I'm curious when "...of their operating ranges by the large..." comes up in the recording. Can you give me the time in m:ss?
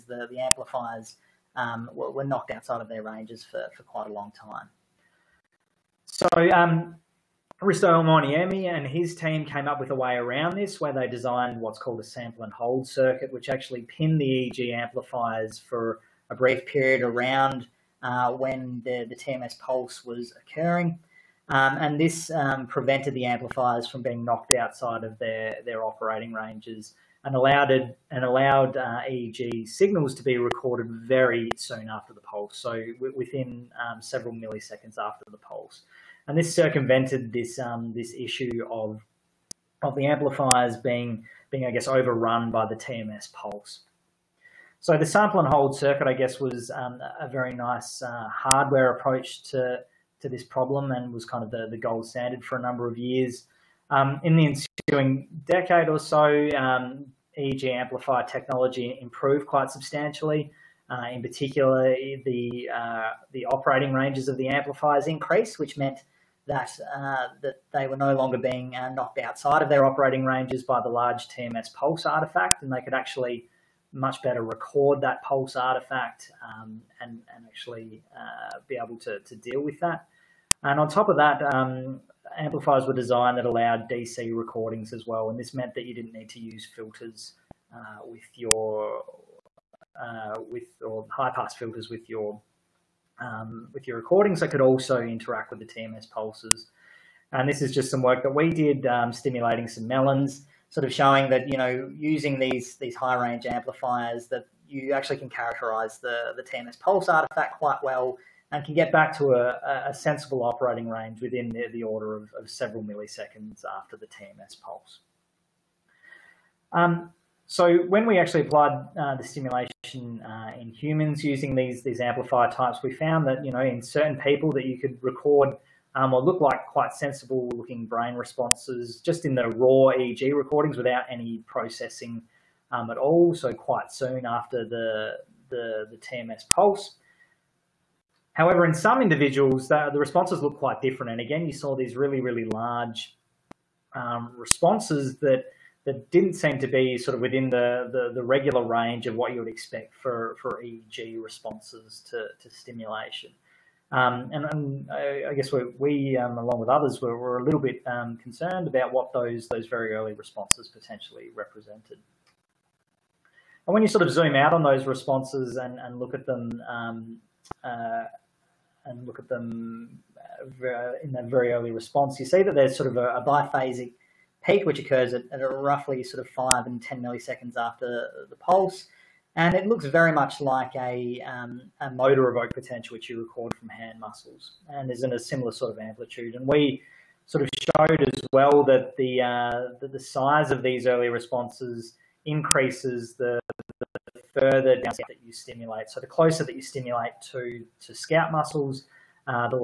1:09.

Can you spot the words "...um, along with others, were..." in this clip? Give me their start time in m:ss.
2:36.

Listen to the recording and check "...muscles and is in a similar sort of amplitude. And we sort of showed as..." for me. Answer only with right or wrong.
right.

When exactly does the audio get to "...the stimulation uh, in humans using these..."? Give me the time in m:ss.
1:59.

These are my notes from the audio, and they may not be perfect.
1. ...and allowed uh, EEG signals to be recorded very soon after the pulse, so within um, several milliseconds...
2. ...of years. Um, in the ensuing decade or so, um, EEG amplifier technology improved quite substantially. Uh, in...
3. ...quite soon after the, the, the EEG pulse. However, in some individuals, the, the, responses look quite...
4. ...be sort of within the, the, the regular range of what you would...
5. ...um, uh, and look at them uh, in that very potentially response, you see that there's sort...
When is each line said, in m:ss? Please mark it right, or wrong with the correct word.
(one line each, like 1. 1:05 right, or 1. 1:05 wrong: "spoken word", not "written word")
1. 0:28 right
2. 0:52 right
3. 2:13 wrong: "TMS", not "EEG"
4. 2:26 right
5. 2:46 wrong: "early", not "potentially".